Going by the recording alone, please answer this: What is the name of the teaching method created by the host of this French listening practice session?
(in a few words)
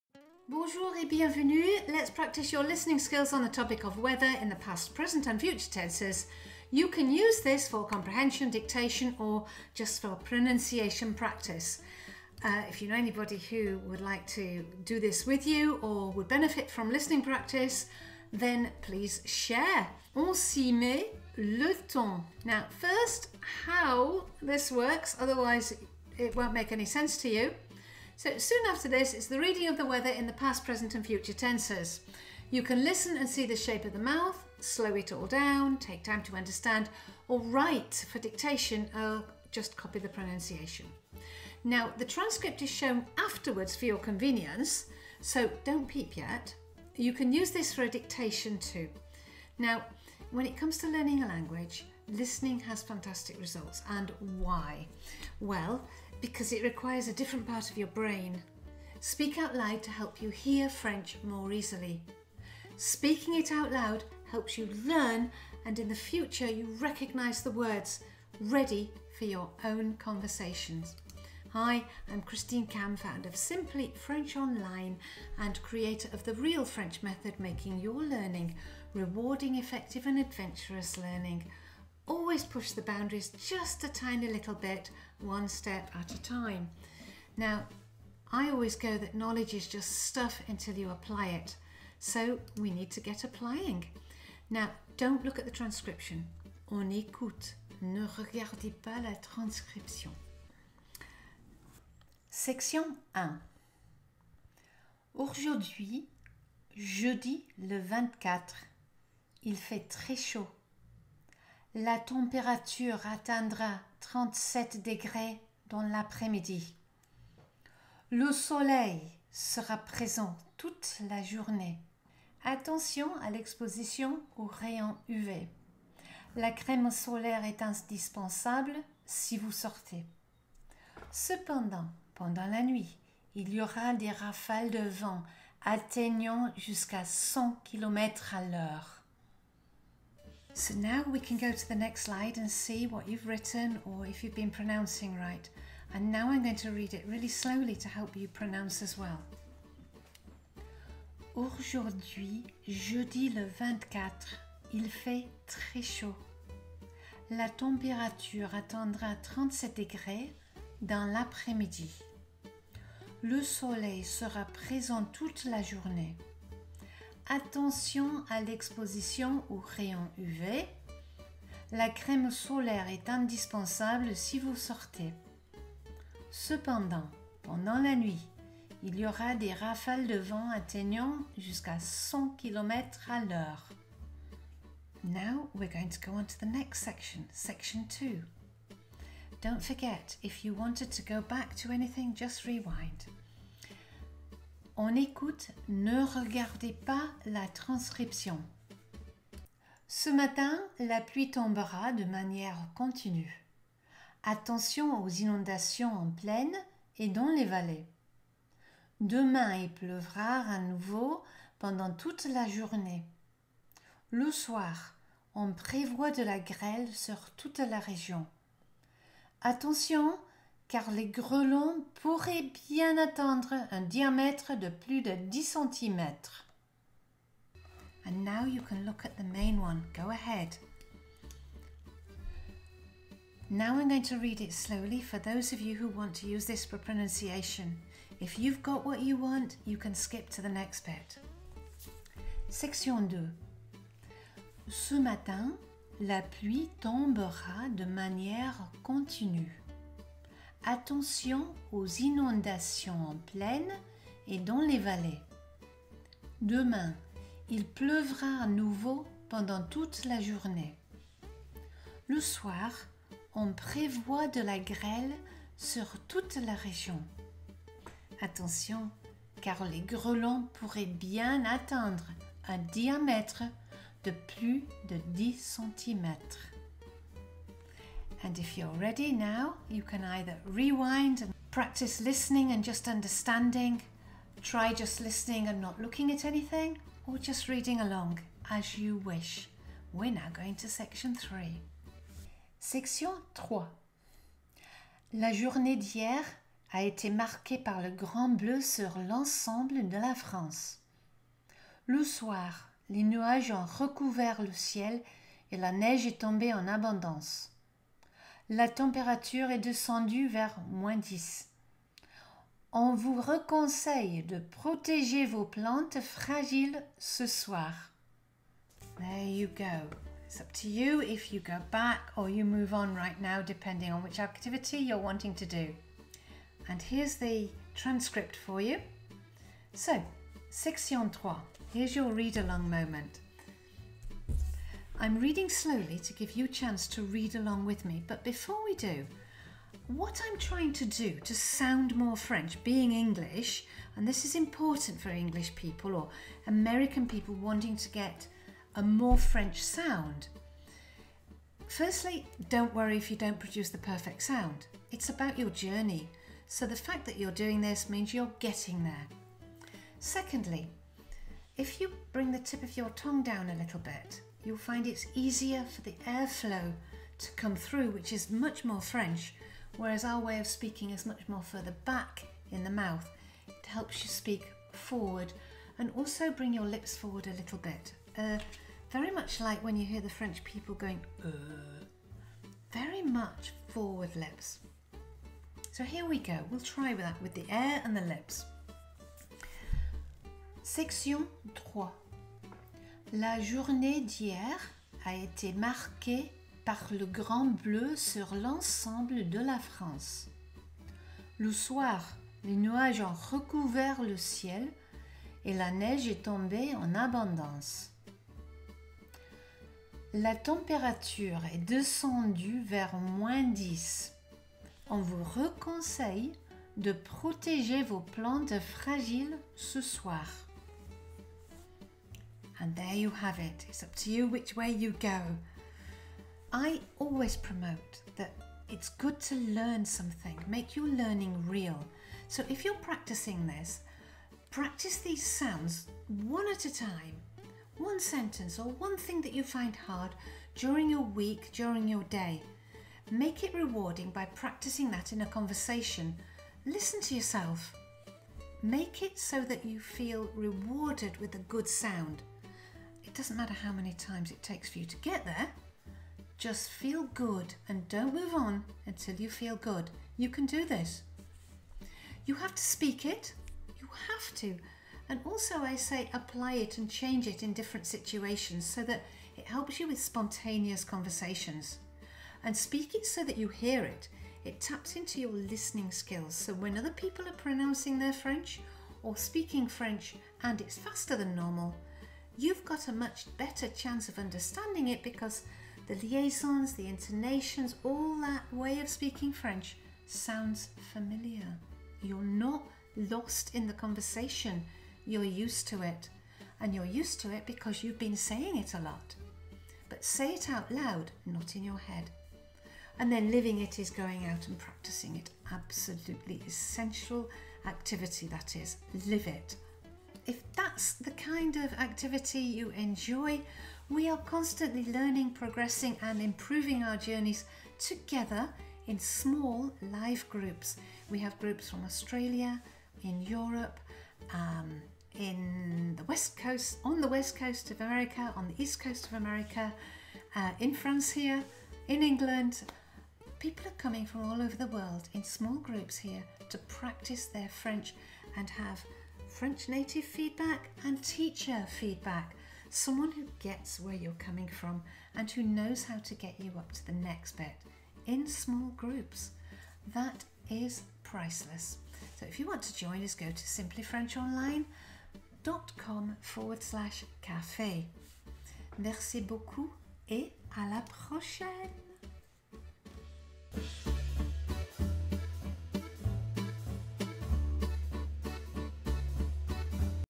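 Real French Method.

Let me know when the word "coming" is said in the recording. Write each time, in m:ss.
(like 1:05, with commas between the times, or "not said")
8:53, 9:04.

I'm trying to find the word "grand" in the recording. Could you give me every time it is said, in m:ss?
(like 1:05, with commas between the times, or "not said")
4:57, 6:37.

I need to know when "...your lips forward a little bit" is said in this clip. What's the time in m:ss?
6:16.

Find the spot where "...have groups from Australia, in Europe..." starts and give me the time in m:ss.
8:41.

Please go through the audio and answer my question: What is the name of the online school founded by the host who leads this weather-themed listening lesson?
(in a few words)
Simply French Online.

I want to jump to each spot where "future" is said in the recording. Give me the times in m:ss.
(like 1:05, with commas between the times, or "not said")
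0:05, 0:31, 1:05.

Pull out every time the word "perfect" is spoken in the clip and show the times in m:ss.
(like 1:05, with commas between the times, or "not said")
5:53.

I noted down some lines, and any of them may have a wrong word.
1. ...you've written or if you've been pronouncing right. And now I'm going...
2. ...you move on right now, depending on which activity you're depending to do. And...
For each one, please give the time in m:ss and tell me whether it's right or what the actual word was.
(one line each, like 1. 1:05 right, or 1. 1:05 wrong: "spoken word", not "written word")
1. 2:23 right
2. 5:22 wrong: "wanting", not "depending".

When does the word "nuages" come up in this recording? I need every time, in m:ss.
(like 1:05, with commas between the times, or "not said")
5:03, 6:42.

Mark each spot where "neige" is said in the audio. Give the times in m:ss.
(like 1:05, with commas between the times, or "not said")
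5:05, 6:45.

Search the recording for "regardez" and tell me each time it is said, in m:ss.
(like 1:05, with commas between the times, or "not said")
1:38, 3:16.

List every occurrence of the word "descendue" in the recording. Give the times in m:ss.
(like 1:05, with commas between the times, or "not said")
5:09, 6:51.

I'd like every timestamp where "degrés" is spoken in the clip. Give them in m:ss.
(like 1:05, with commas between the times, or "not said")
1:54, 2:39.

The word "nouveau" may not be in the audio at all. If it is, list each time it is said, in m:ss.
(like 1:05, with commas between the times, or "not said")
3:30, 4:18.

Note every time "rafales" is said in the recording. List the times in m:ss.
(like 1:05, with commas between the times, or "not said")
2:14, 2:59.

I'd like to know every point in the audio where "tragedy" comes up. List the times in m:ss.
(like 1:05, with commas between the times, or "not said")
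not said.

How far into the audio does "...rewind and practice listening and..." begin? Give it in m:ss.
4:40.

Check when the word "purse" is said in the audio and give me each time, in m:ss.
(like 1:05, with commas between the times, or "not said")
not said.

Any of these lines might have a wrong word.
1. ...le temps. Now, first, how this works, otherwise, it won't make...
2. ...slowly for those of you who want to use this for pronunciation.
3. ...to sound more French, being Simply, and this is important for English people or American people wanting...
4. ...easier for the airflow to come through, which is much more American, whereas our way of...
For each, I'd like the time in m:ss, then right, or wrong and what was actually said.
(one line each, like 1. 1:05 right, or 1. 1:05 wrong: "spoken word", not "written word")
1. 0:21 right
2. 3:54 right
3. 5:41 wrong: "English", not "Simply"
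4. 6:05 wrong: "French", not "American".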